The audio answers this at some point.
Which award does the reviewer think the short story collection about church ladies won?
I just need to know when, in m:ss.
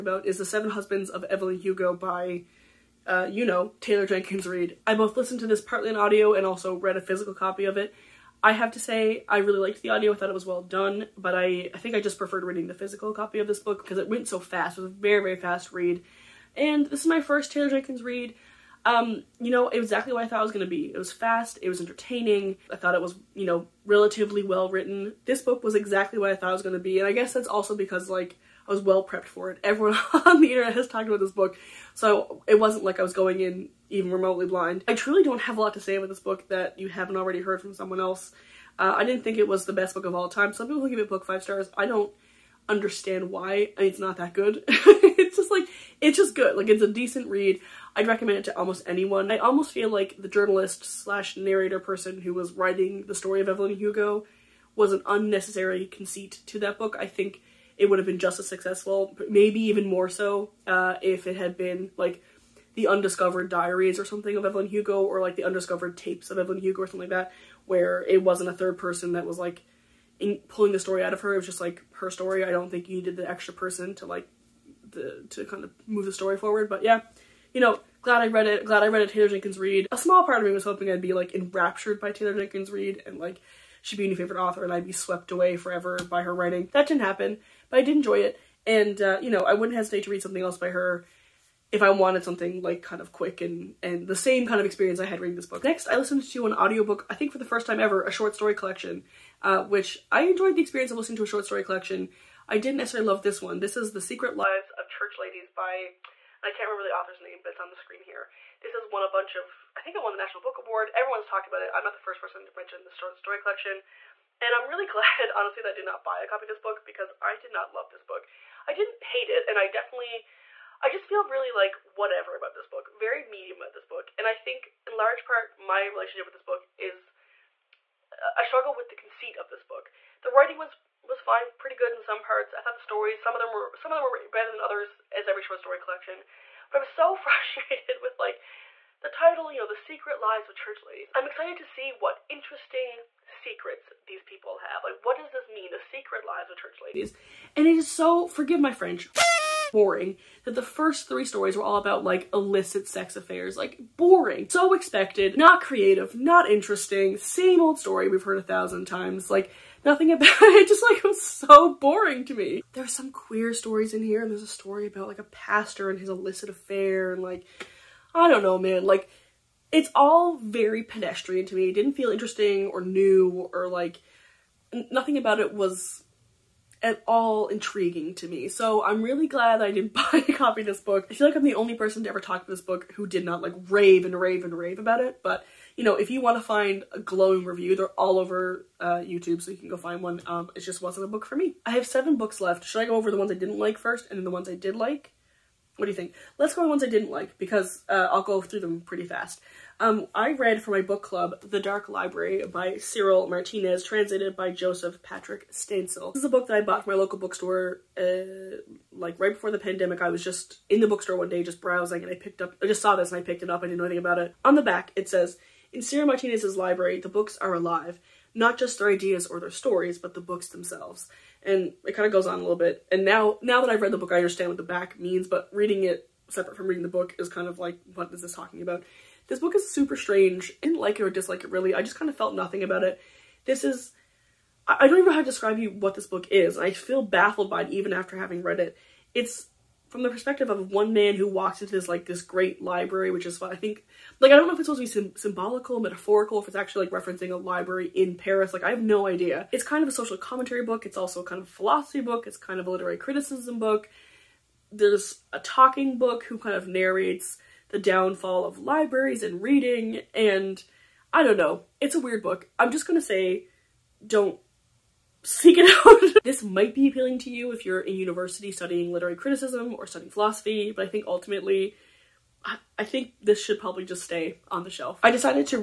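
1:50.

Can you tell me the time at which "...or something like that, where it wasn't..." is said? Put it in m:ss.
1:06.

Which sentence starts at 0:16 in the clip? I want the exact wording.
And this is my first Taylor Jenkins Reid.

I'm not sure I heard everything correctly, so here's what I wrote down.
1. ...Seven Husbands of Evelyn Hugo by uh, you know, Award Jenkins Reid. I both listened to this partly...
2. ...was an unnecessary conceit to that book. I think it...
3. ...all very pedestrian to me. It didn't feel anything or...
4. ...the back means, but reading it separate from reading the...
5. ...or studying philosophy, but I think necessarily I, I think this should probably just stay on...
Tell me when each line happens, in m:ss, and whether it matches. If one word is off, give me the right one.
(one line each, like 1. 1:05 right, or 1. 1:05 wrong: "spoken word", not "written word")
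1. 0:00 wrong: "Taylor", not "Award"
2. 0:54 right
3. 2:49 wrong: "interesting", not "anything"
4. 3:44 right
5. 4:29 wrong: "ultimately", not "necessarily".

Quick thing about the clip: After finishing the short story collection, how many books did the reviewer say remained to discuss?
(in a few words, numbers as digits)
7.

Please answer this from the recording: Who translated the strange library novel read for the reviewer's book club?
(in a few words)
Joseph Patrick Stansel.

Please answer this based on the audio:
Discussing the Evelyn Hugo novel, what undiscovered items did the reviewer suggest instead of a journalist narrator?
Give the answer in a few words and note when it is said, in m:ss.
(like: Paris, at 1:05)
diaries, at 1:02.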